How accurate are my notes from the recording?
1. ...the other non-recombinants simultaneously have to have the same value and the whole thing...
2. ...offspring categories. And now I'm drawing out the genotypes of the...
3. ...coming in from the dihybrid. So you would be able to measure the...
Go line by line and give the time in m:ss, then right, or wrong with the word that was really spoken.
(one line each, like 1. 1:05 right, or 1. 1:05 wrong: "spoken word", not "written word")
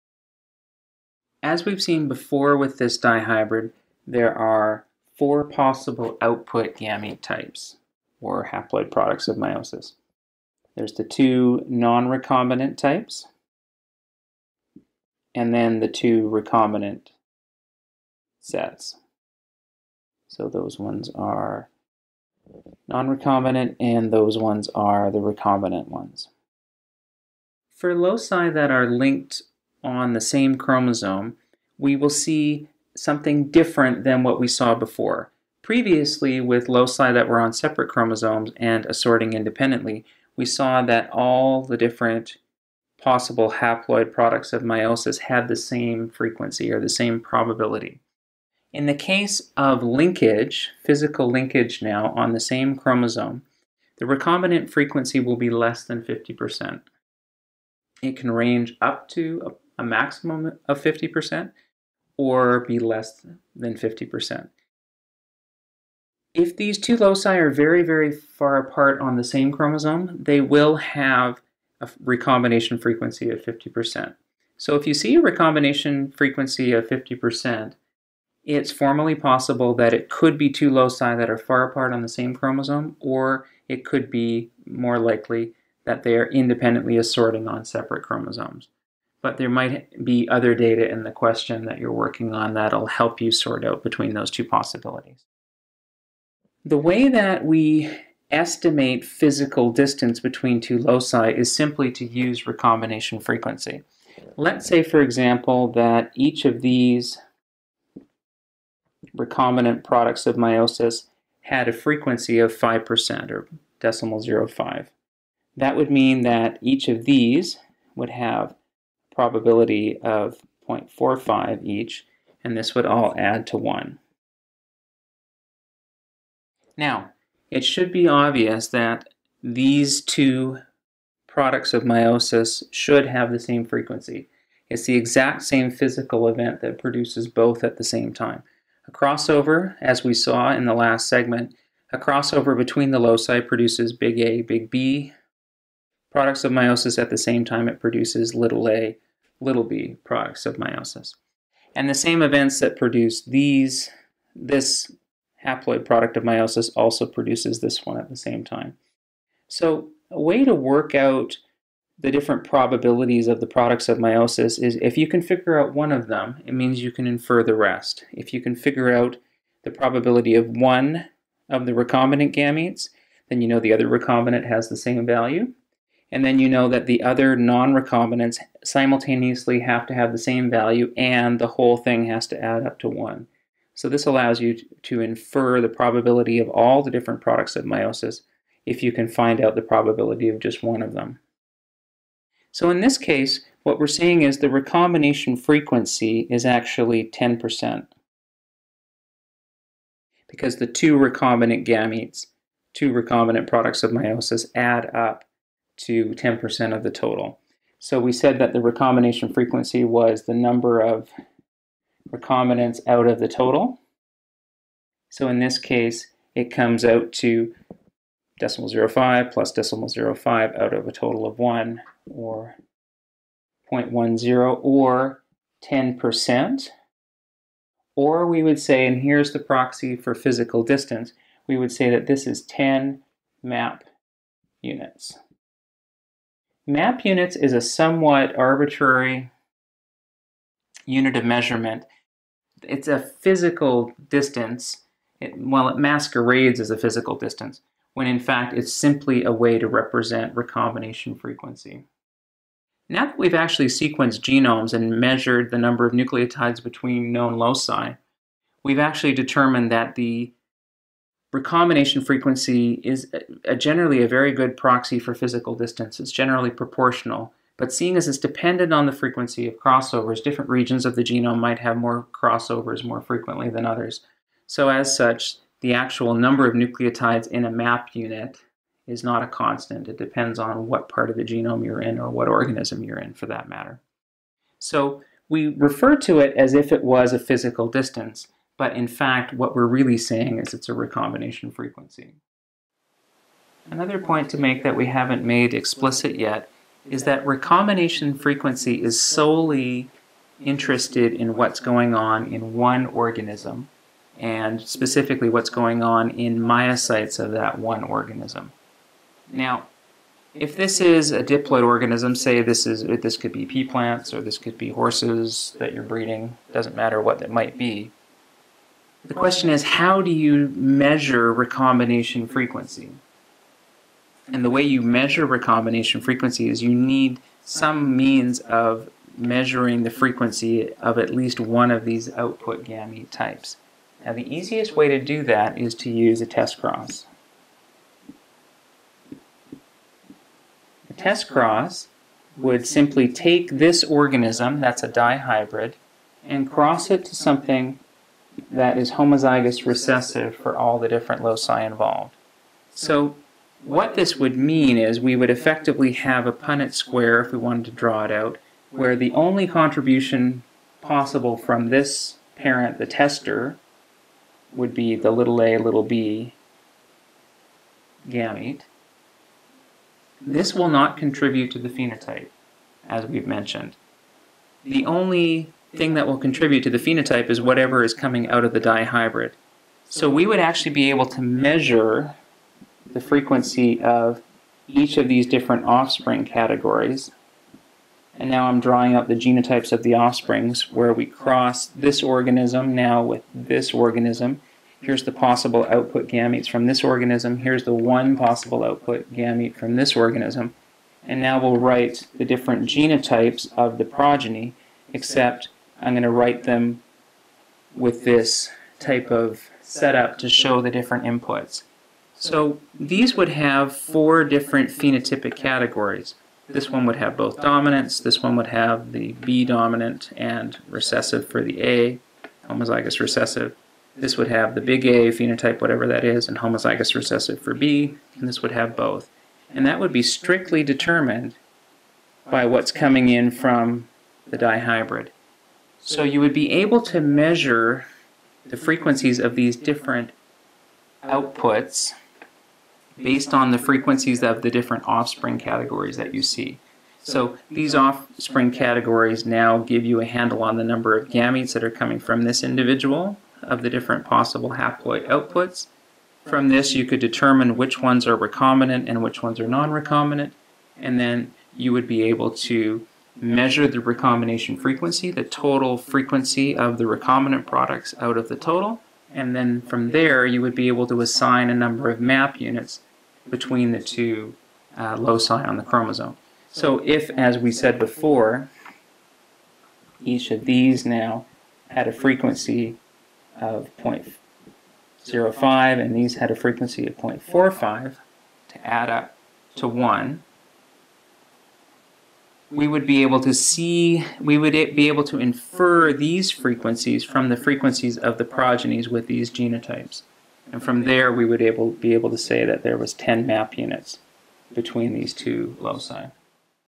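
1. 2:56 right
2. 6:25 right
3. 7:12 right.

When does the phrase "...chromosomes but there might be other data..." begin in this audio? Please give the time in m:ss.
1:28.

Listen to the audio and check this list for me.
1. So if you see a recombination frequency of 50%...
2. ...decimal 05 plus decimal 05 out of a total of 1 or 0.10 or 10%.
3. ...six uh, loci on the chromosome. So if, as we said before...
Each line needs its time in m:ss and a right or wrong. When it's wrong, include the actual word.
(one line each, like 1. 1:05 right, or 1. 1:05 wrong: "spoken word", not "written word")
1. 1:14 right
2. 3:38 right
3. 7:53 wrong: "two", not "six".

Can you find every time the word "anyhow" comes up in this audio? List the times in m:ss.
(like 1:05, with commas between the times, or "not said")
not said.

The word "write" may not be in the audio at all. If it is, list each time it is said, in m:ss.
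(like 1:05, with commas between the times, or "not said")
6:41, 6:46.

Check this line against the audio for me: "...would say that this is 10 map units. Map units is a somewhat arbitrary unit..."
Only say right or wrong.
right.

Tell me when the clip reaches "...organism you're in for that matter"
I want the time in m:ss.
4:42.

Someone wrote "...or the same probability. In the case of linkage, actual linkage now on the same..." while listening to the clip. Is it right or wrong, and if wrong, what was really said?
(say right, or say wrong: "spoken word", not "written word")
wrong: "physical", not "actual".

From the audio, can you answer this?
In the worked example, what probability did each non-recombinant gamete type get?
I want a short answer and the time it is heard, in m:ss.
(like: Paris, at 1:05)
0.45, at 2:00.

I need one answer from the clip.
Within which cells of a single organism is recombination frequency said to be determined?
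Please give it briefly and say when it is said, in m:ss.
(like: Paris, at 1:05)
meiocytes, at 5:06.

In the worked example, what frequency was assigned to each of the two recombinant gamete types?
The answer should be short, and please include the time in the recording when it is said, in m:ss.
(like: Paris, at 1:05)
5%, at 1:52.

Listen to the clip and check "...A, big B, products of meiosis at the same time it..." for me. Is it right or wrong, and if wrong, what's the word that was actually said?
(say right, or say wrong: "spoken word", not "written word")
right.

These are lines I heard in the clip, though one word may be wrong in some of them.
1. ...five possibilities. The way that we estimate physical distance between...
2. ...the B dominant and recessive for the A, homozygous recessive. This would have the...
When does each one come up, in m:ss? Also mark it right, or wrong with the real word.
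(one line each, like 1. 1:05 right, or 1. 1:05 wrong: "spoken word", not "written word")
1. 1:34 wrong: "two", not "five"
2. 6:58 right.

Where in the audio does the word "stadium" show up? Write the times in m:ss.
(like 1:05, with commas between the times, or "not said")
not said.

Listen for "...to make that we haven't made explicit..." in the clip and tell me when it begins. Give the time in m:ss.
4:54.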